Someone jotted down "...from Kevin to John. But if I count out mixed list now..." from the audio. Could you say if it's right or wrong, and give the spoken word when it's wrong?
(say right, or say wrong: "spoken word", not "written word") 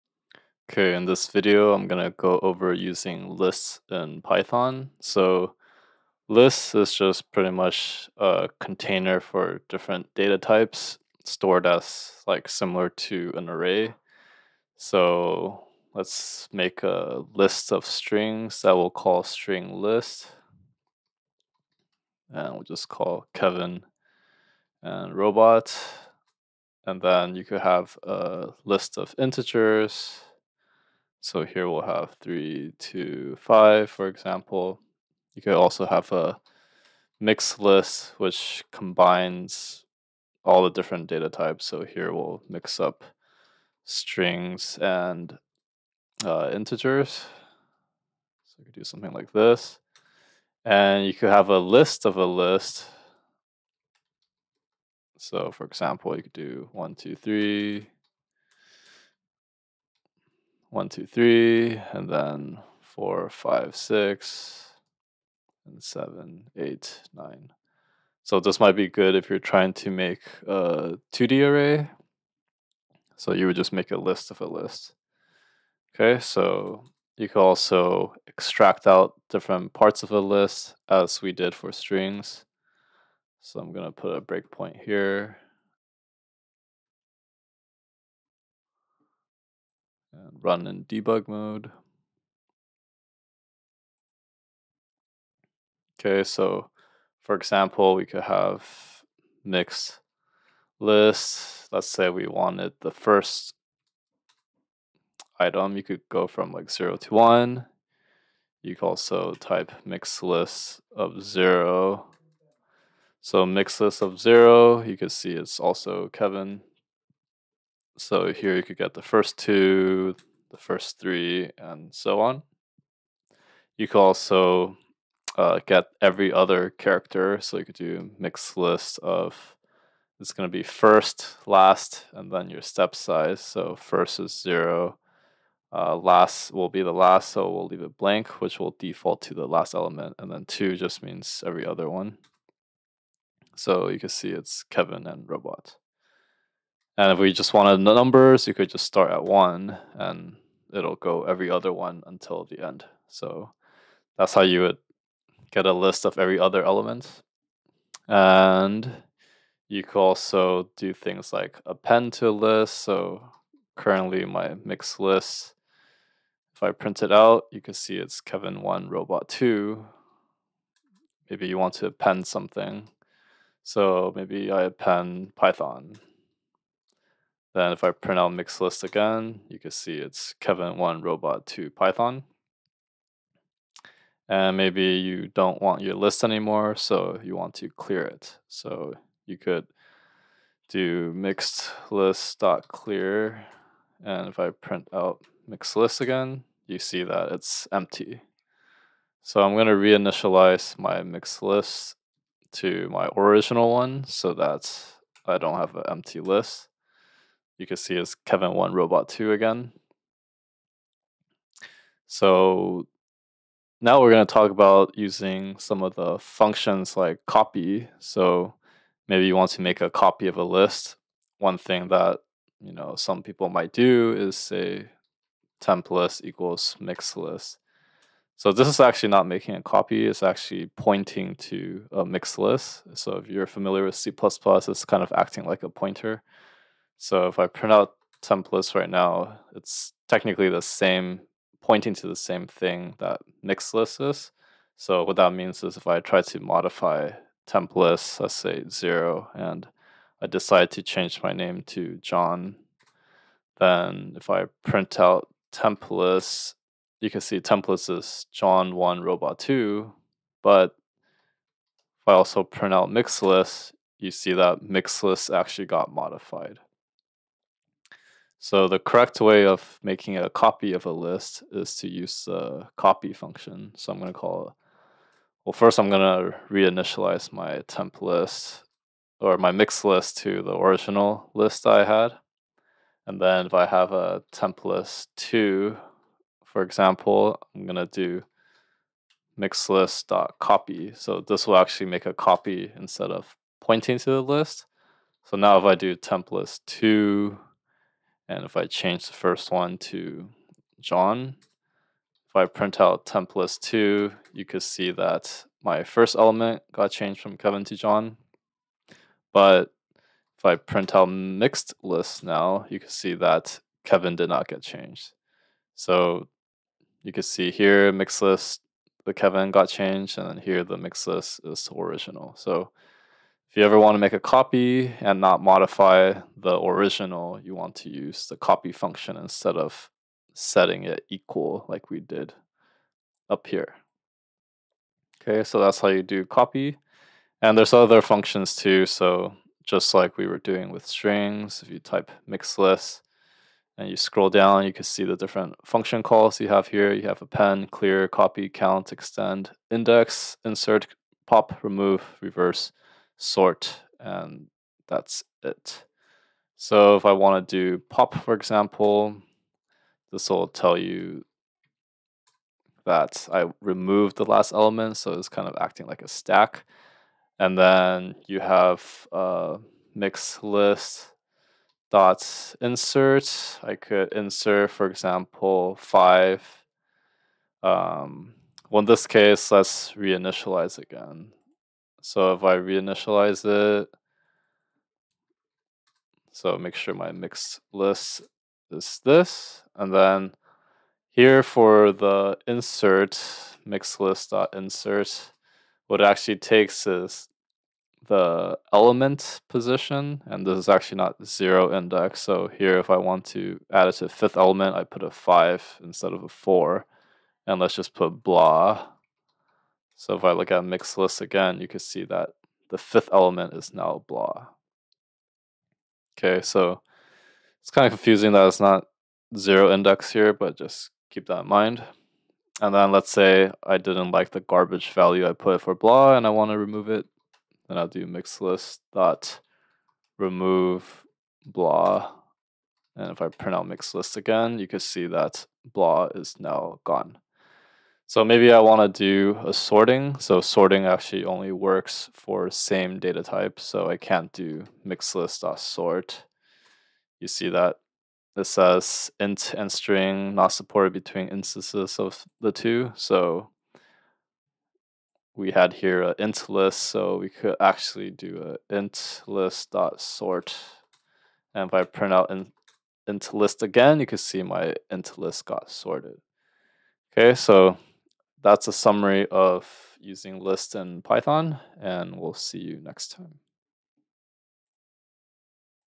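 wrong: "print", not "count".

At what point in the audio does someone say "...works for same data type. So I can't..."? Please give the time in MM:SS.
07:21.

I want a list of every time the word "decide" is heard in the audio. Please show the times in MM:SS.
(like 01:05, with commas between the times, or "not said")
04:10.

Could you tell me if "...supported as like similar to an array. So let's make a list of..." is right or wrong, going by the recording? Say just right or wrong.
wrong.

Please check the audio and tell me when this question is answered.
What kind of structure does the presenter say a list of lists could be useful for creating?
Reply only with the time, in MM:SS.
01:11.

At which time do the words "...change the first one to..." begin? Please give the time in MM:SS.
04:58.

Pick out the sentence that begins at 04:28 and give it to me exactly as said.
So the correct way of making a copy of a list is to use the copy function.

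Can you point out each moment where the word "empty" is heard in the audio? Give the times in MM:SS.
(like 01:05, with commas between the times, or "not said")
03:17, 03:25.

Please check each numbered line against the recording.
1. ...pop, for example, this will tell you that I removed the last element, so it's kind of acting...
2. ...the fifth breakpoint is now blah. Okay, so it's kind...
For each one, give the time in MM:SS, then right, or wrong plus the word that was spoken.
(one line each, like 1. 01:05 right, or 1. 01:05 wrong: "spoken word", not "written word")
1. 05:57 right
2. 06:52 wrong: "element", not "breakpoint".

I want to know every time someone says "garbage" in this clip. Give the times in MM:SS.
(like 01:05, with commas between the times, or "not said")
07:04.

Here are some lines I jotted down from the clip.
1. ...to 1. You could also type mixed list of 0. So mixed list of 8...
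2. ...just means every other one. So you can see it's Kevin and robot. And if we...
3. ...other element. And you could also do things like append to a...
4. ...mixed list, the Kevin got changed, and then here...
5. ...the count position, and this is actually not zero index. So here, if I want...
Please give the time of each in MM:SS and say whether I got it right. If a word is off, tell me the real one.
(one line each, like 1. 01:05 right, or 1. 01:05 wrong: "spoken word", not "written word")
1. 01:46 wrong: "0", not "8"
2. 02:20 right
3. 02:36 right
4. 05:17 right
5. 06:38 wrong: "element", not "count".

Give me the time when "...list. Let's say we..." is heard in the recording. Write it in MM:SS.
01:40.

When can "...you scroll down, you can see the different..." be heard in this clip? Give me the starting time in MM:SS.
05:43.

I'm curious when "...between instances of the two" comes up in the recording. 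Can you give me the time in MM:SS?
07:30.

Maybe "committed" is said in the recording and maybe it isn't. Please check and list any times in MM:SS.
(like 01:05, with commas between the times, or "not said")
not said.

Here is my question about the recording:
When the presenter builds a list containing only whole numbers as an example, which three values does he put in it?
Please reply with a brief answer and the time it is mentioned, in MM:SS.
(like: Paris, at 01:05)
3, 2, 5, at 00:32.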